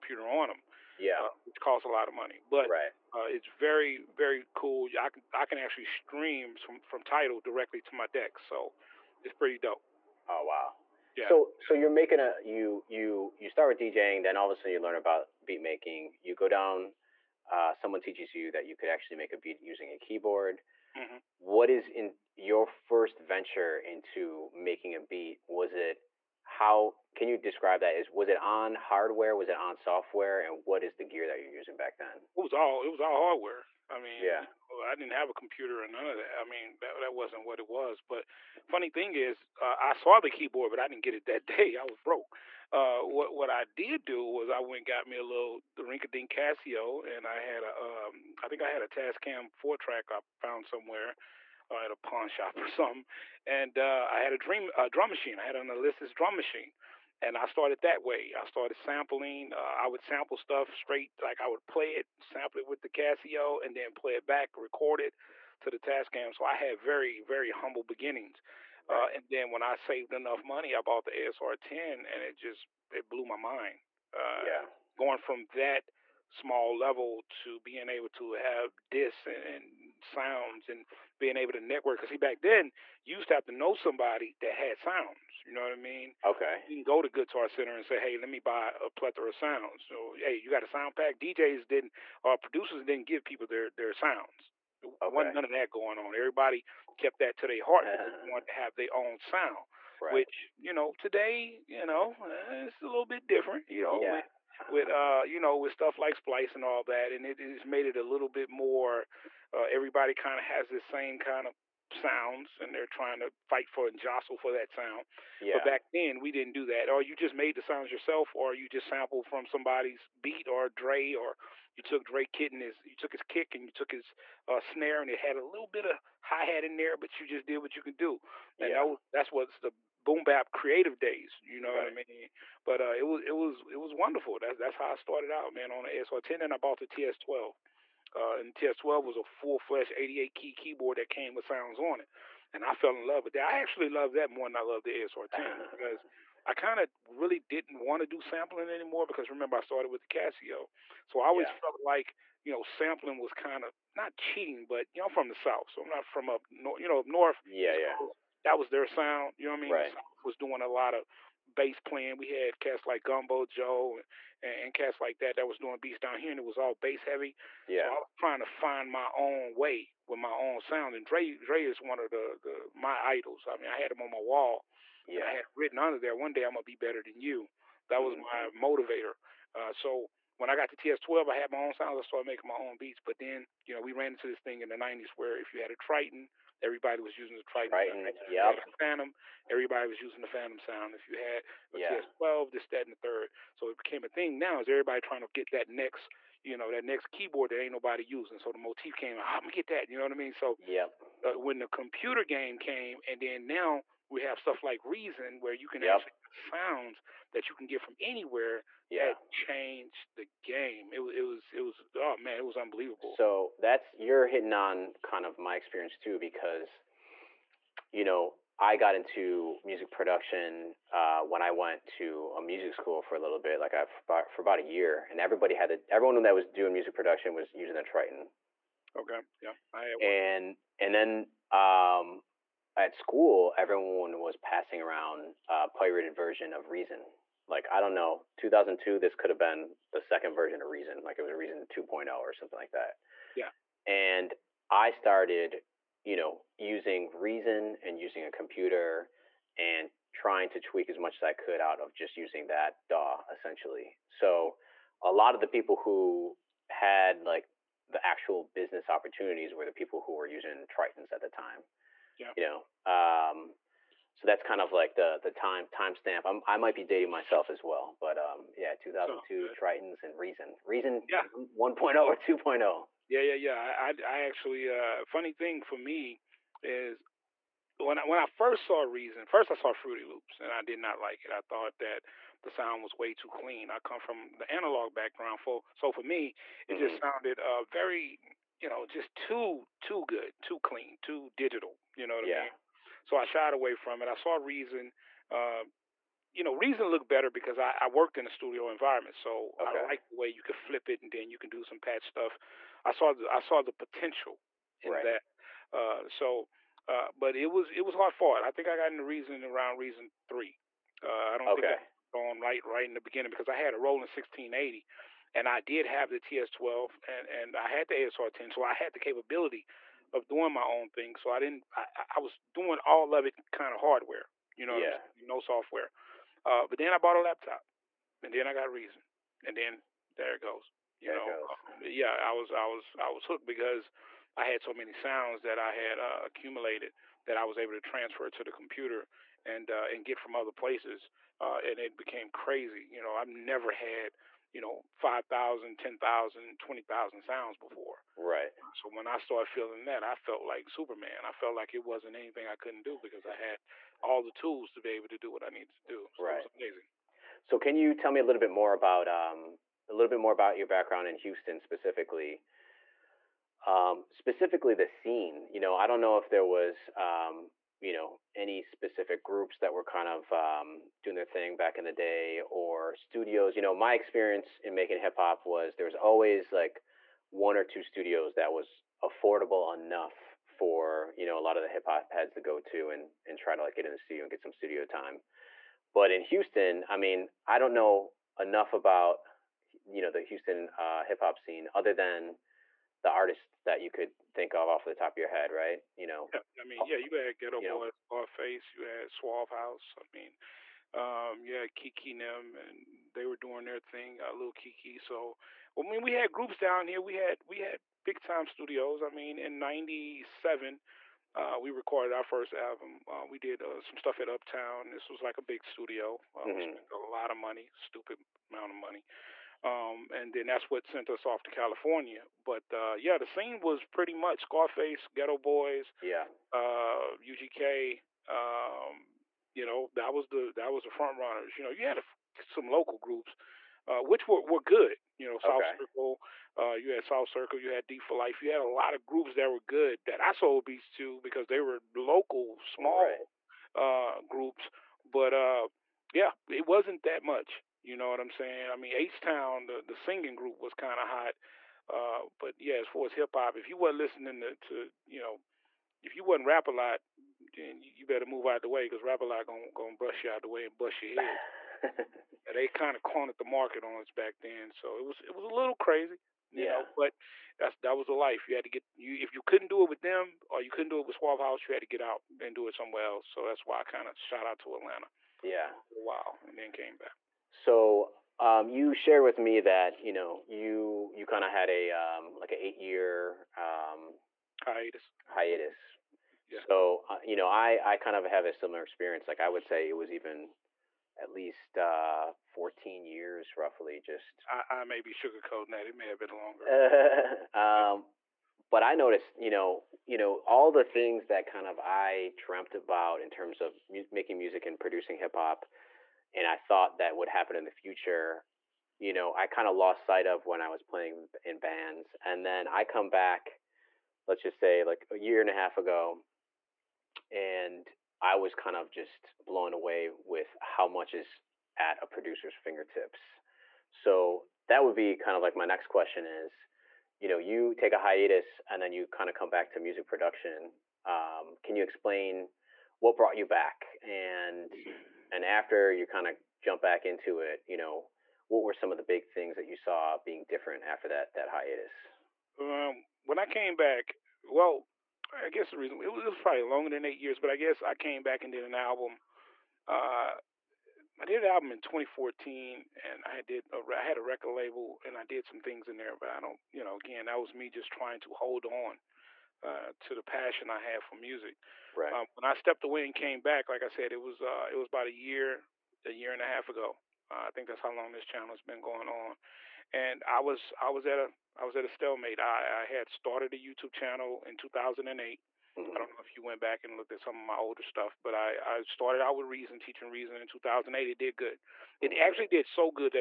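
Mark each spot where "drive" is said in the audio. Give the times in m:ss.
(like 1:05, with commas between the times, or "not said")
not said.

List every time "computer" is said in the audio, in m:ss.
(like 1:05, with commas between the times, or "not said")
0:35, 3:21, 4:08, 5:38.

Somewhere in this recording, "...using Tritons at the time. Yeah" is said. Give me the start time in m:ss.
4:20.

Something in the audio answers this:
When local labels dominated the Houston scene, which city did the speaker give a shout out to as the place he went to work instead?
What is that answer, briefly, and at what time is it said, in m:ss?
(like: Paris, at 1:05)
Atlanta, at 7:54.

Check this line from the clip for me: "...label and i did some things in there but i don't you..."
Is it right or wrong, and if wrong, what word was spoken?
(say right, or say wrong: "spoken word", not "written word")
right.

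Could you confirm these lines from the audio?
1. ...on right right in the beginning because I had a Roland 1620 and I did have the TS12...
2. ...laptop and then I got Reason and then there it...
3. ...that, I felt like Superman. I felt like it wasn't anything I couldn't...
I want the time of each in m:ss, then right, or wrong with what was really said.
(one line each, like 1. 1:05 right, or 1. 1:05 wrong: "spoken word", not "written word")
1. 5:12 wrong: "1680", not "1620"
2. 5:27 right
3. 5:49 right.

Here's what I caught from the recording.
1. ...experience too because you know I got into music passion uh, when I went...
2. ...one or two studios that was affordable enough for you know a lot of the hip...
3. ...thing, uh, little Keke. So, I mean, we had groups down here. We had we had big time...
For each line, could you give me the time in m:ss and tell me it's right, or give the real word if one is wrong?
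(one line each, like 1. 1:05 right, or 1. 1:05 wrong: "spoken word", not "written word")
1. 3:35 wrong: "production", not "passion"
2. 6:17 right
3. 6:43 right.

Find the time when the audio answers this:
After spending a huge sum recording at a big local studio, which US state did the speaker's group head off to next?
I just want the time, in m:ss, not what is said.
7:01.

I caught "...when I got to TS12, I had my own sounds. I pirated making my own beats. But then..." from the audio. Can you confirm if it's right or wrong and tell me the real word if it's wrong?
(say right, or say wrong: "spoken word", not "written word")
wrong: "started", not "pirated".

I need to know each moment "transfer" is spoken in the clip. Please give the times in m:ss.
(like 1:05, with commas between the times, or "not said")
5:37.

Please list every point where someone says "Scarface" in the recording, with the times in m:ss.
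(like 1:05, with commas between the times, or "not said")
6:38, 7:04.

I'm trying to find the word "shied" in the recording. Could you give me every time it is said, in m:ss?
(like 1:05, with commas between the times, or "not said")
4:53.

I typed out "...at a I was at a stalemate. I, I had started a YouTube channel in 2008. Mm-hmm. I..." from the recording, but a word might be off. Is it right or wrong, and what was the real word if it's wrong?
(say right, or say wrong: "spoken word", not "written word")
right.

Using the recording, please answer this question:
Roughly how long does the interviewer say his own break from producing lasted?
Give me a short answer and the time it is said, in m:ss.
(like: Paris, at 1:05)
14 years, at 8:12.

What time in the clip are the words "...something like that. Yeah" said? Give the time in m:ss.
4:02.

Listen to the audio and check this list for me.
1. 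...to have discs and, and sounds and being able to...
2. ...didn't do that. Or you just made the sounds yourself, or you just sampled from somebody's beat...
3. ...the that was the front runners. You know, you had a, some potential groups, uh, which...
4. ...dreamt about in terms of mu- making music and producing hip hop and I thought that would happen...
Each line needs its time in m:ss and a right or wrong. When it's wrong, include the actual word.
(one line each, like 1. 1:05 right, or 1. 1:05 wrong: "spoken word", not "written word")
1. 1:18 right
2. 1:56 right
3. 7:10 wrong: "local", not "potential"
4. 8:22 right.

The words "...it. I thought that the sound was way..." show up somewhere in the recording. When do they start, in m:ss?
4:41.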